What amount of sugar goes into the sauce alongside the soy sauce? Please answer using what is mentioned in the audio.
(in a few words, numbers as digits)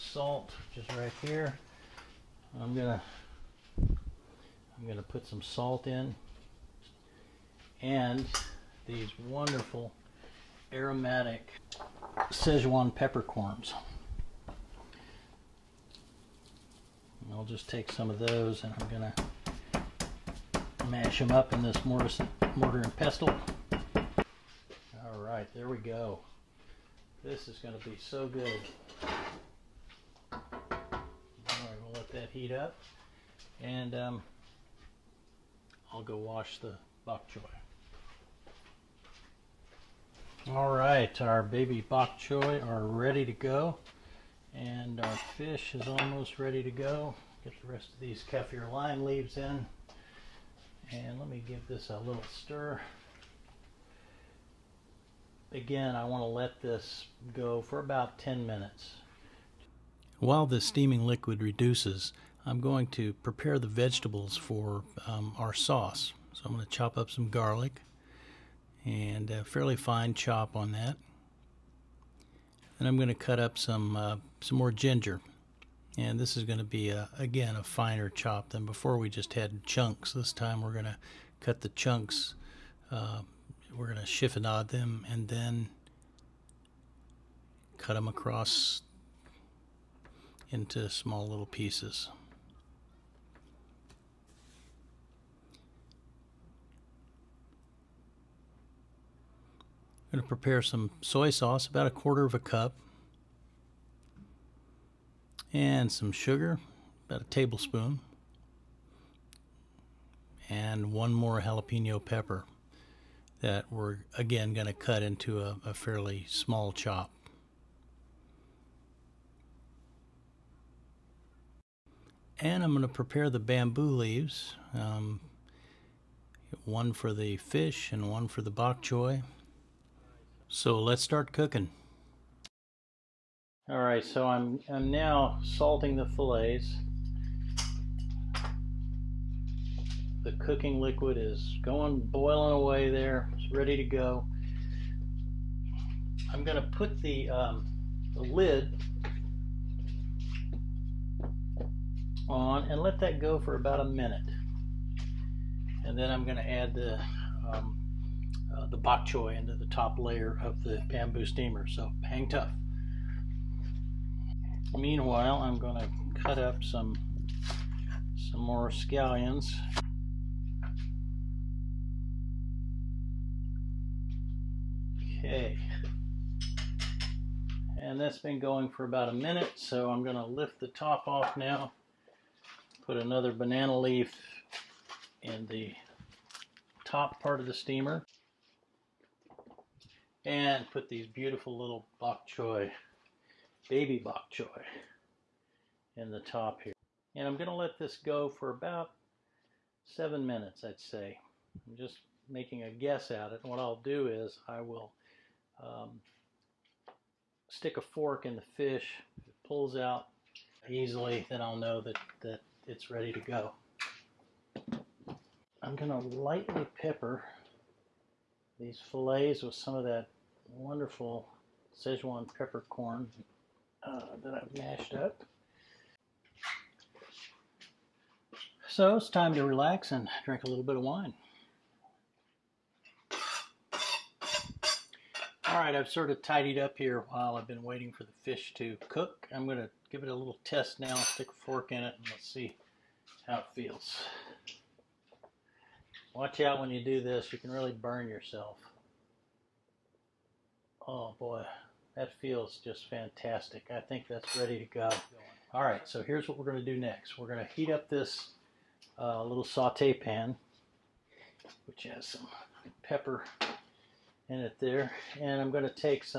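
a tablespoon.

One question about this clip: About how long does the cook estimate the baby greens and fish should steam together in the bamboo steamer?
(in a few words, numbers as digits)
7 minutes.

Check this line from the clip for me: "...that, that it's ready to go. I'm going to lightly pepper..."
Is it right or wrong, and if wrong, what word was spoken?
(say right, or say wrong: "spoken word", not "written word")
right.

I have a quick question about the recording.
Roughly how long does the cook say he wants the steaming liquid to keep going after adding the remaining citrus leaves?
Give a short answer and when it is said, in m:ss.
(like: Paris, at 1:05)
10 minutes, at 0:57.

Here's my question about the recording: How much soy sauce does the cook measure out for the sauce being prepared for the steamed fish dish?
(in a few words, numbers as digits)
a quarter of a cup.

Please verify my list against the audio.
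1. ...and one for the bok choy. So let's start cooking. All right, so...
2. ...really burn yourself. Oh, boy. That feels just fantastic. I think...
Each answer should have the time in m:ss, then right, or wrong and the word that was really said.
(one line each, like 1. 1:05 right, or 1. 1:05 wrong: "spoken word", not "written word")
1. 2:07 right
2. 4:07 right.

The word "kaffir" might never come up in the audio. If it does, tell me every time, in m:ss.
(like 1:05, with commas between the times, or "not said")
0:48.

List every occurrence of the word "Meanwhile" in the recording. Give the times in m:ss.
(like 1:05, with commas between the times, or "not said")
2:44.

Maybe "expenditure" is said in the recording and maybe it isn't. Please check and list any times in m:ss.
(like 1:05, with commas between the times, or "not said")
not said.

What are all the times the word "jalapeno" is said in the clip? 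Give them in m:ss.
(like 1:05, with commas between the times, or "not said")
1:51.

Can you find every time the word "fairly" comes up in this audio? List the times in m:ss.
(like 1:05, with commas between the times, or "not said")
1:09, 1:55.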